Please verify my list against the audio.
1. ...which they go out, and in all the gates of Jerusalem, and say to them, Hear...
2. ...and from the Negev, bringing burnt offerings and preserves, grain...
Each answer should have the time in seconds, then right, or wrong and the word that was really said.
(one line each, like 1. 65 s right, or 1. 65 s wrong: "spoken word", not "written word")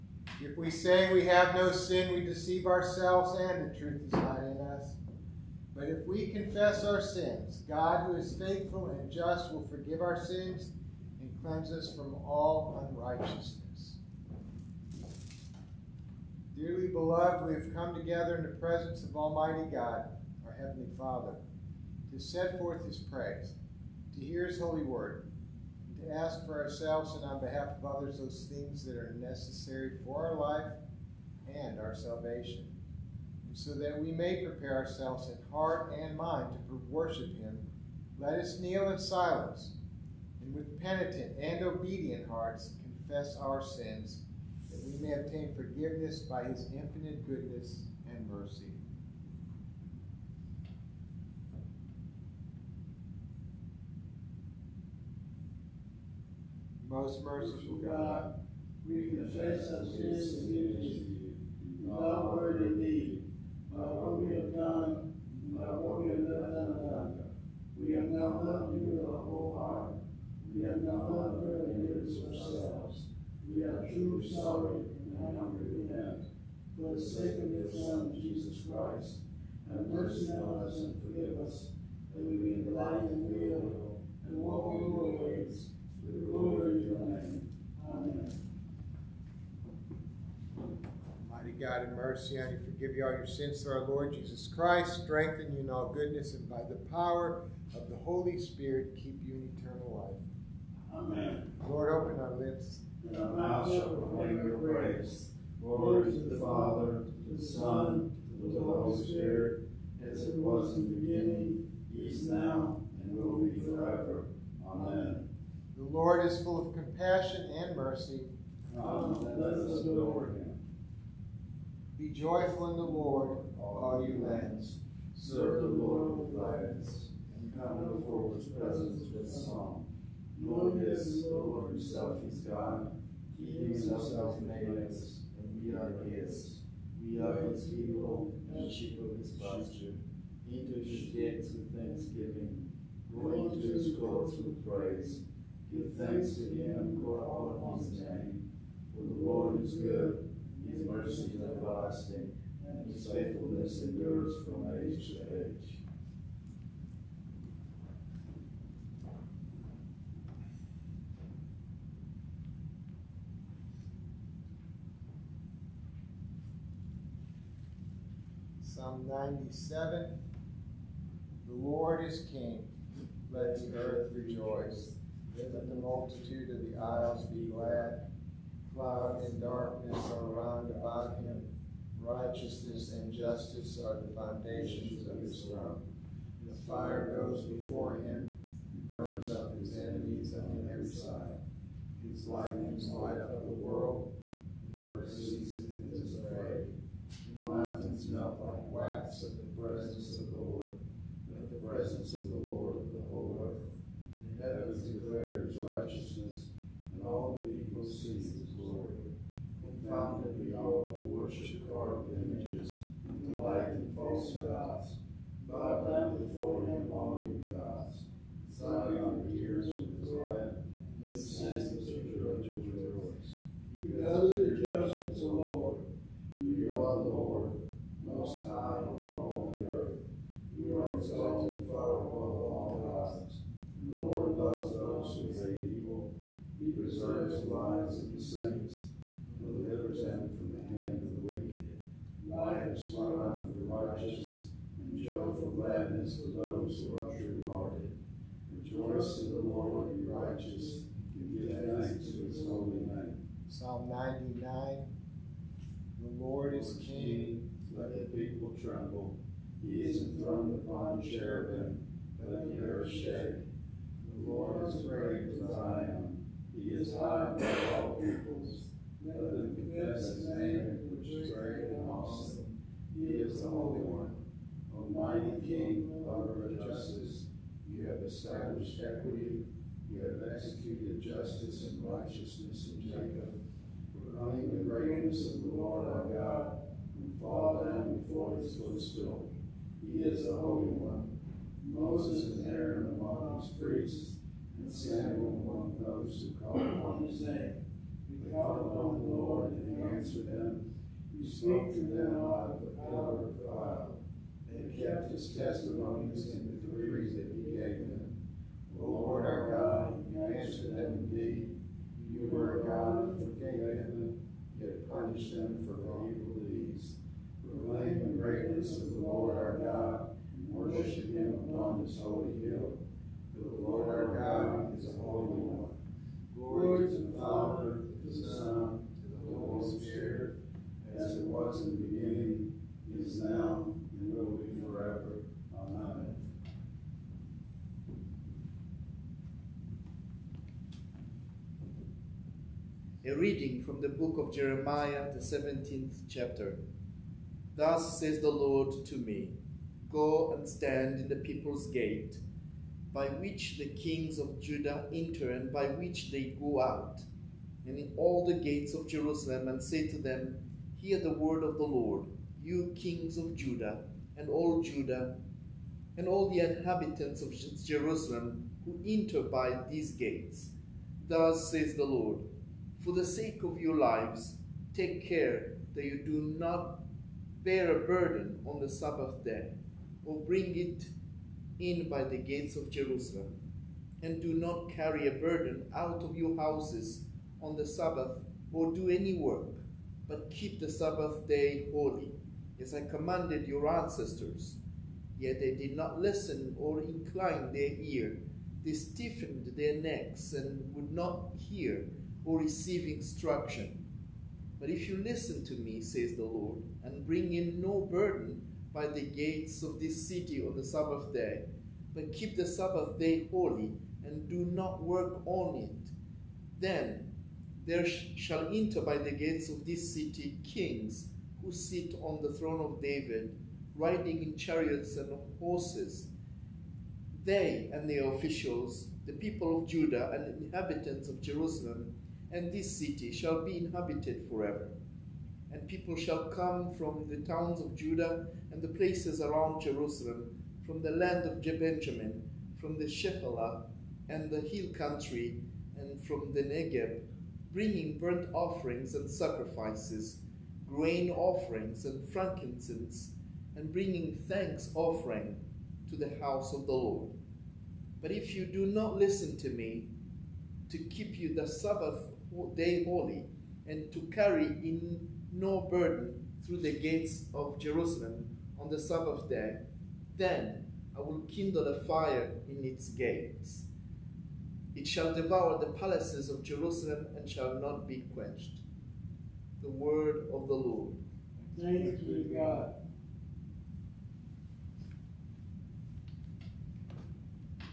1. 355 s right
2. 445 s wrong: "sacrifices", not "preserves".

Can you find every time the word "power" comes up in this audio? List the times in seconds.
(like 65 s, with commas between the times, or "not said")
96 s, 302 s.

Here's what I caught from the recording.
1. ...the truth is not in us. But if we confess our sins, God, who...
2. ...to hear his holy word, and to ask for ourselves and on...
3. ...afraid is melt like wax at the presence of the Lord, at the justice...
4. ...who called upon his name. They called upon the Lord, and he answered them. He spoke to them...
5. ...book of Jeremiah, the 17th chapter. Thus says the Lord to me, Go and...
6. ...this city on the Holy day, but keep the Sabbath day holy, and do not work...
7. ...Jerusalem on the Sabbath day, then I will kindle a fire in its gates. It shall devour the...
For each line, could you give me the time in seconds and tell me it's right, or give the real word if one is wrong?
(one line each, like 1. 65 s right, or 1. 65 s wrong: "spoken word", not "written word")
1. 3 s right
2. 24 s right
3. 196 s wrong: "presence", not "justice"
4. 296 s right
5. 343 s right
6. 409 s wrong: "Sabbath", not "Holy"
7. 467 s right.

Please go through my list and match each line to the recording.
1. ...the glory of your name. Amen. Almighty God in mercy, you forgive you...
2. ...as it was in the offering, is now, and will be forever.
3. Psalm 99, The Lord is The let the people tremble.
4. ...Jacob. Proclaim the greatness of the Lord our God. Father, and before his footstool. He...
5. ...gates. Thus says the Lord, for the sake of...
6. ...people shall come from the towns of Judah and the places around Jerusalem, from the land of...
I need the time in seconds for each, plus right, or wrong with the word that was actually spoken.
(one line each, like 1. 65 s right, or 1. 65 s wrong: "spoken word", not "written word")
1. 86 s right
2. 110 s wrong: "beginning", not "offering"
3. 253 s wrong: "King", not "The"
4. 282 s right
5. 369 s right
6. 435 s right.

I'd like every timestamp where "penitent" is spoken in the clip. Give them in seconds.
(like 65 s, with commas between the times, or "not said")
40 s.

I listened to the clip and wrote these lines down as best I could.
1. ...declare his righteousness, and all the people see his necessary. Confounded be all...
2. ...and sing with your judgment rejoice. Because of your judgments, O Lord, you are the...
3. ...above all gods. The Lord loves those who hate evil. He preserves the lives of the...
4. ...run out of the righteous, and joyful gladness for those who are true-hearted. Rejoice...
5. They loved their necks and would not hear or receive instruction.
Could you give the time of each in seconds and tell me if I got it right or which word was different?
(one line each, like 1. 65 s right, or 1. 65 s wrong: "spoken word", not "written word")
1. 204 s wrong: "glory", not "necessary"
2. 221 s right
3. 232 s right
4. 242 s right
5. 398 s wrong: "stiffened", not "loved".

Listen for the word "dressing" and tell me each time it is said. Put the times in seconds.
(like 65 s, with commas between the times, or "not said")
not said.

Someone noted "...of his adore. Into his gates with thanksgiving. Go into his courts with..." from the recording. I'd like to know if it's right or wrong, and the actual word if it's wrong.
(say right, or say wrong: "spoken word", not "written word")
wrong: "pasture", not "adore".